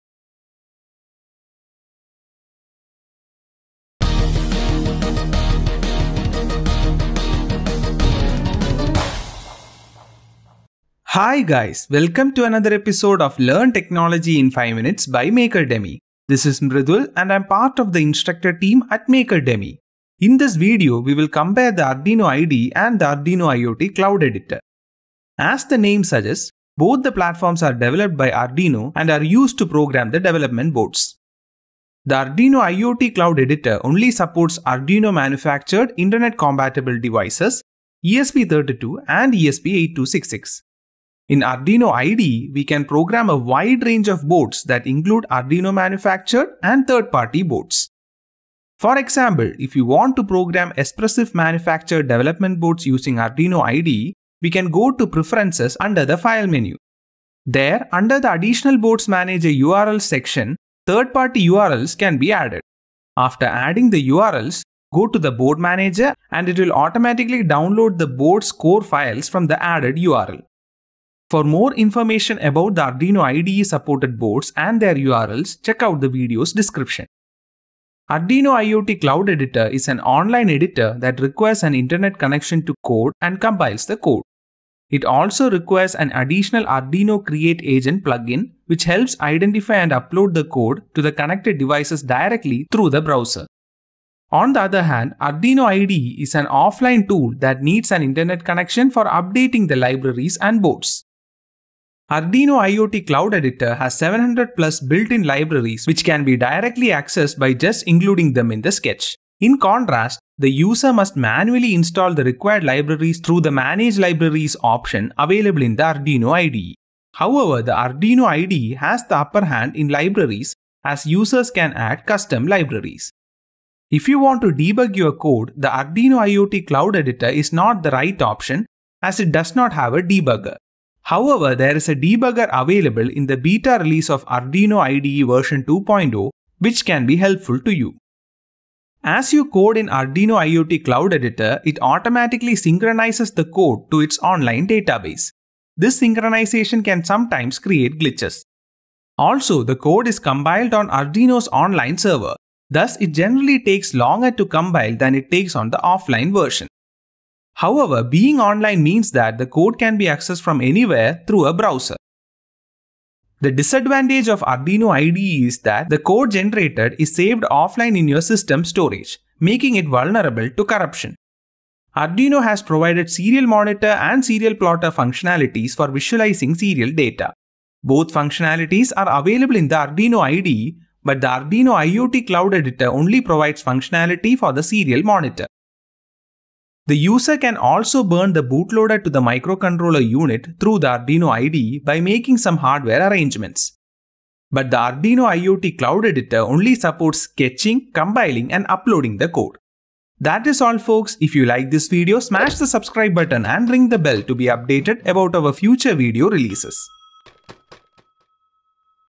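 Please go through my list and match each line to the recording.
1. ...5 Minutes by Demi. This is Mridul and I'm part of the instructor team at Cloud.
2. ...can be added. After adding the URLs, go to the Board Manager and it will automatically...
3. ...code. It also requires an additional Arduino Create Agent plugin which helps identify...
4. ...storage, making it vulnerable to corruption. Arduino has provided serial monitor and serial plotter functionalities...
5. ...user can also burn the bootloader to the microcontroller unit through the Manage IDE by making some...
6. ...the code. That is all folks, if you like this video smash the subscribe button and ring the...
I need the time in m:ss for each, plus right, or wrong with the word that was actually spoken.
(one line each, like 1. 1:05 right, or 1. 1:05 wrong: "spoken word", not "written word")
1. 0:14 wrong: "Demi", not "Cloud"
2. 1:01 right
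3. 1:23 right
4. 2:48 right
5. 3:06 wrong: "Arduino", not "Manage"
6. 3:19 right.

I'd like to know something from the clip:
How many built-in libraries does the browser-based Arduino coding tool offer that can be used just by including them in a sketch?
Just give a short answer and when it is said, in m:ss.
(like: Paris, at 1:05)
700+, at 1:43.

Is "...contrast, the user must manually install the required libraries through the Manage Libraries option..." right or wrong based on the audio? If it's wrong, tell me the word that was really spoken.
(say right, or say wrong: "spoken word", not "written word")
right.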